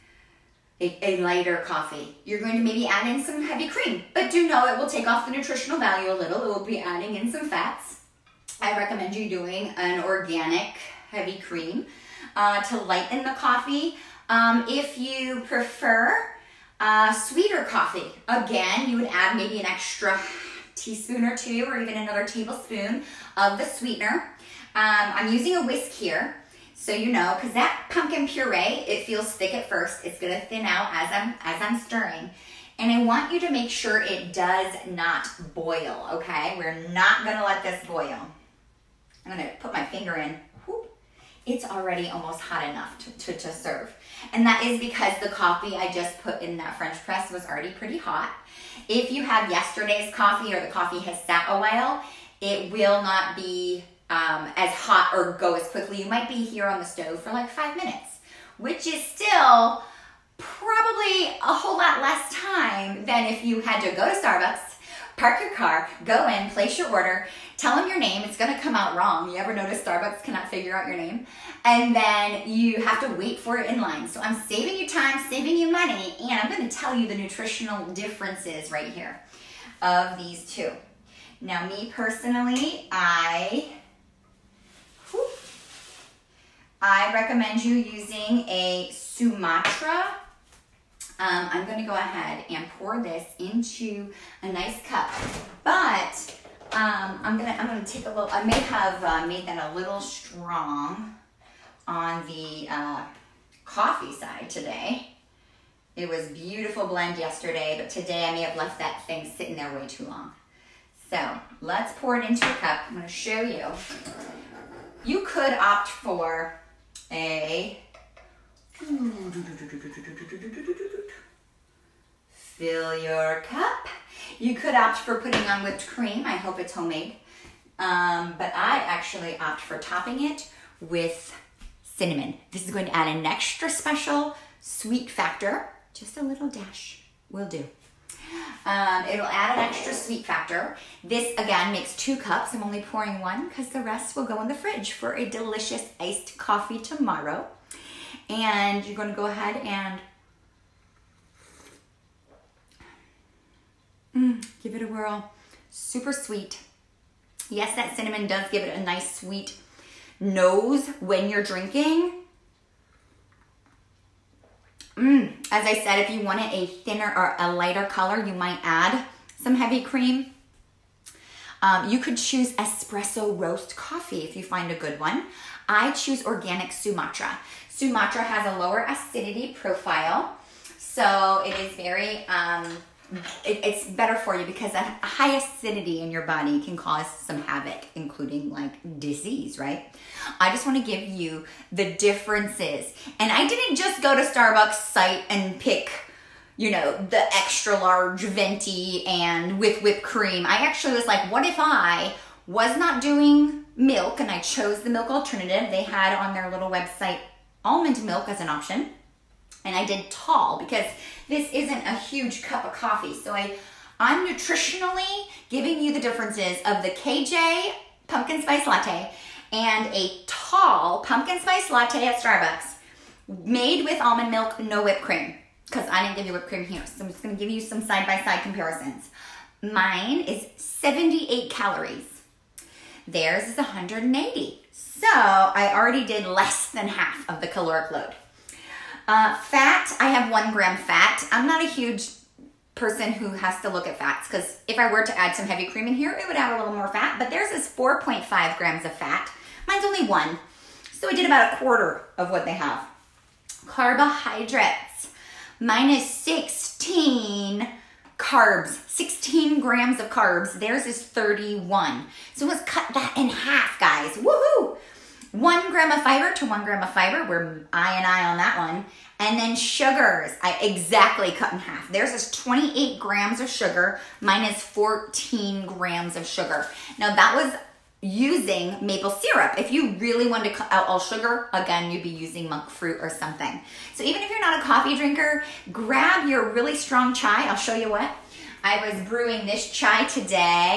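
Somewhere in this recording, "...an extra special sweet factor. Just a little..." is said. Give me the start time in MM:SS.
02:13.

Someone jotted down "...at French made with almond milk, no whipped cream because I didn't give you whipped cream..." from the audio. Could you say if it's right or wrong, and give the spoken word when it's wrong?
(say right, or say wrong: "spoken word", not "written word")
wrong: "Starbucks", not "French".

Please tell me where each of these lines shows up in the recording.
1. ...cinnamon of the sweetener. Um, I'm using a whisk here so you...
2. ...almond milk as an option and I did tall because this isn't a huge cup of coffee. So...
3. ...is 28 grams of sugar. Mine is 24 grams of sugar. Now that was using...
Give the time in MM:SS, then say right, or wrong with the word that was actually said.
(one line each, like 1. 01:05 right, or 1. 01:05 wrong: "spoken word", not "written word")
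1. 00:22 wrong: "tablespoon", not "cinnamon"
2. 03:27 right
3. 04:32 wrong: "14", not "24".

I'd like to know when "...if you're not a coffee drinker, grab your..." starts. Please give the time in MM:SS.
04:44.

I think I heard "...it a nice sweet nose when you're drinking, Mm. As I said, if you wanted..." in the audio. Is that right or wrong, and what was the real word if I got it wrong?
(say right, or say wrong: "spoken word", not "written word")
right.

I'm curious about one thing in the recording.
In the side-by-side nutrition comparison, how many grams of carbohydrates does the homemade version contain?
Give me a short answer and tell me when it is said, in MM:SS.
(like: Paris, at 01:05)
16 grams, at 04:18.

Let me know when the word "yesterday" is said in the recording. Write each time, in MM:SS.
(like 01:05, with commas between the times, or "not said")
00:49, 01:47.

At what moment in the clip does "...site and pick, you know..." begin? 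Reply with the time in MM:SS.
03:14.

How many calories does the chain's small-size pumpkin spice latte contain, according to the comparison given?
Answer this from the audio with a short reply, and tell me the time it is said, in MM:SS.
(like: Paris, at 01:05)
180, at 03:53.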